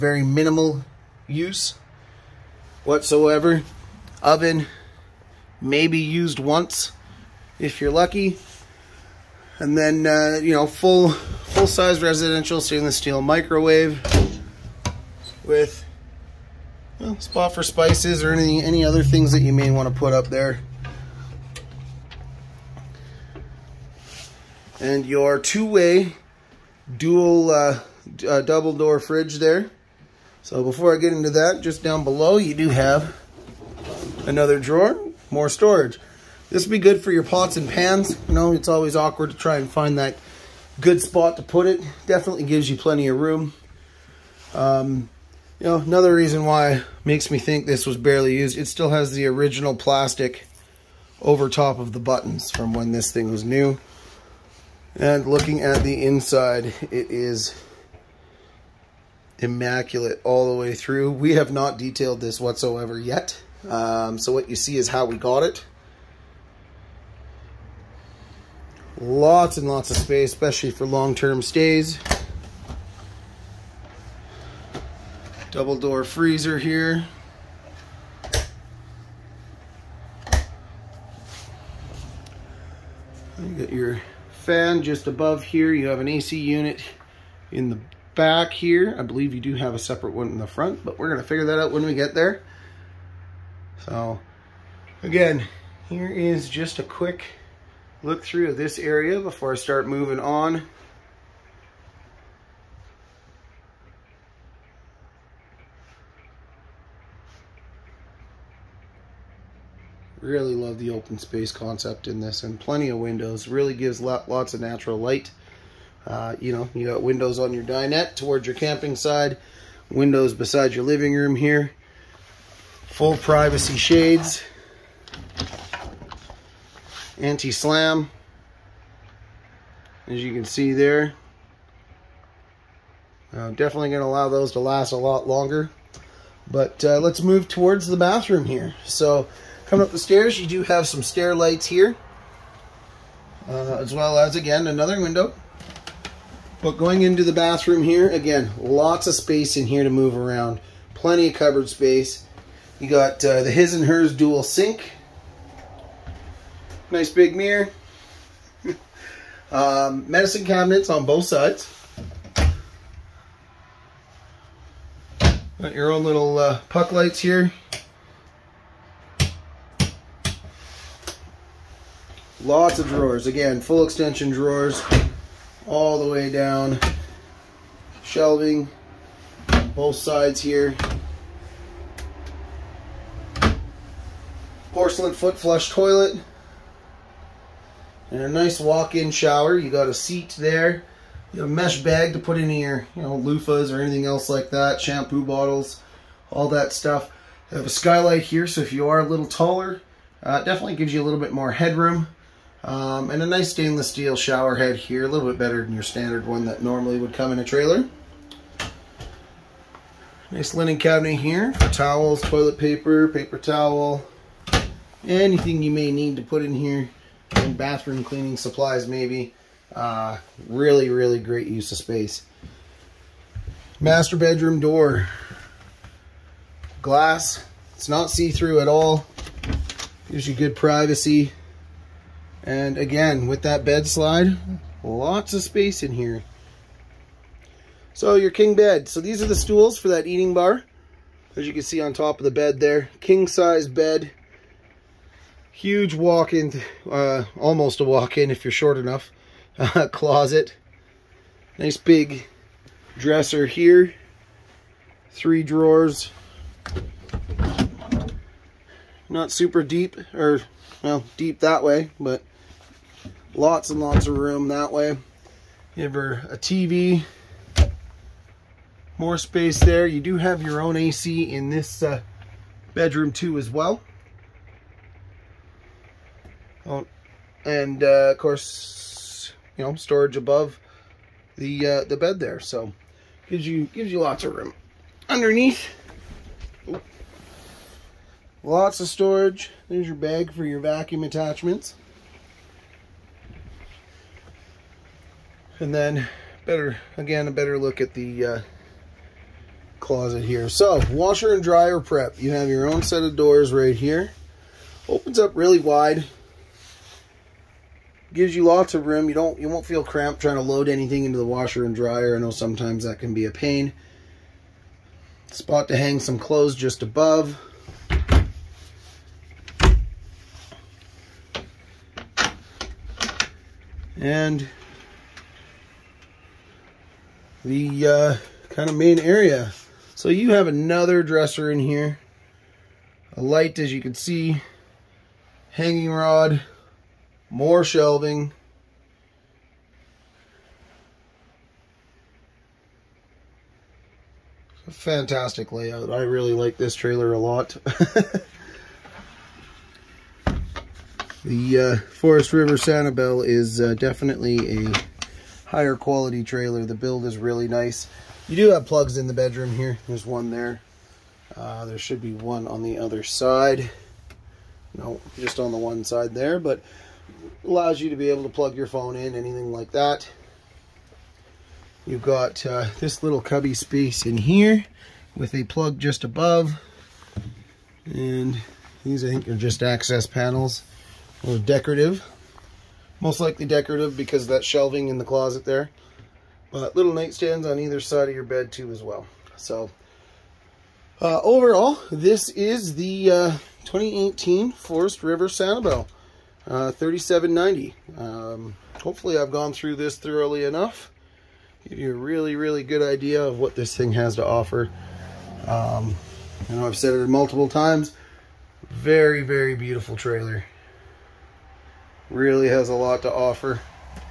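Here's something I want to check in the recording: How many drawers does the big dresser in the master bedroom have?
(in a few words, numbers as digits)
3.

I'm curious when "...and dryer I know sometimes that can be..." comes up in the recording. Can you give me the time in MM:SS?
05:11.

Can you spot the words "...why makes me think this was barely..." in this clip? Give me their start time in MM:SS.
00:46.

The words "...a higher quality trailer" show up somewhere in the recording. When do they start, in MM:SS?
05:54.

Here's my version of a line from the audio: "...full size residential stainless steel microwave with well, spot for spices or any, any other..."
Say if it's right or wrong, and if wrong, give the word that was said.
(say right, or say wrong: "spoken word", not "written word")
right.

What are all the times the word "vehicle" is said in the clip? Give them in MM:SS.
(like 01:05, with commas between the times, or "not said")
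not said.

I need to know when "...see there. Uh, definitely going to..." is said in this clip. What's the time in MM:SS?
02:10.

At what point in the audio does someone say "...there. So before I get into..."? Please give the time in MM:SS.
00:29.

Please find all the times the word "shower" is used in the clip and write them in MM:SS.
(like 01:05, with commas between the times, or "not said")
03:09, 03:24.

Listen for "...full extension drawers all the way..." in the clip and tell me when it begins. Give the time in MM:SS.
02:53.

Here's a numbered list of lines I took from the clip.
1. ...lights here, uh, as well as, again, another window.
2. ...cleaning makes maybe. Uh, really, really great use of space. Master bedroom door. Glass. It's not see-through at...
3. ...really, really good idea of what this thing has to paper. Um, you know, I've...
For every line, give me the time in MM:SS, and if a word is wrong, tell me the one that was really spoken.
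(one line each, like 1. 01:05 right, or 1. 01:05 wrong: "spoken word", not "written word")
1. 02:21 right
2. 03:38 wrong: "supplies", not "makes"
3. 06:41 wrong: "offer", not "paper".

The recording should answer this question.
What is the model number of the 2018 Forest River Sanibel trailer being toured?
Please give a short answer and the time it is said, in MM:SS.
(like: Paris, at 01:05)
3790, at 06:36.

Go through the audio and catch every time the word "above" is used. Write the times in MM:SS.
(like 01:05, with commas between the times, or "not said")
01:25, 04:40, 05:16, 06:16.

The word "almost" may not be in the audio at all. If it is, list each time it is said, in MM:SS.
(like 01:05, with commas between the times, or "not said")
04:07.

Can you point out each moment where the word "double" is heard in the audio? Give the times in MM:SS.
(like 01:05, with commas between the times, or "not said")
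00:28, 01:15.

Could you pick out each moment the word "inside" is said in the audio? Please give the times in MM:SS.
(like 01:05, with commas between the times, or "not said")
00:56.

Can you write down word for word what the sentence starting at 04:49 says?
There's your bag for your vacuum attachments.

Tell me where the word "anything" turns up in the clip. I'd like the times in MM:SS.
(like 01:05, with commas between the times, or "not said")
03:13, 03:35, 05:10, 06:09.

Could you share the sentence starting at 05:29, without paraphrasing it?
So you have another dresser in here.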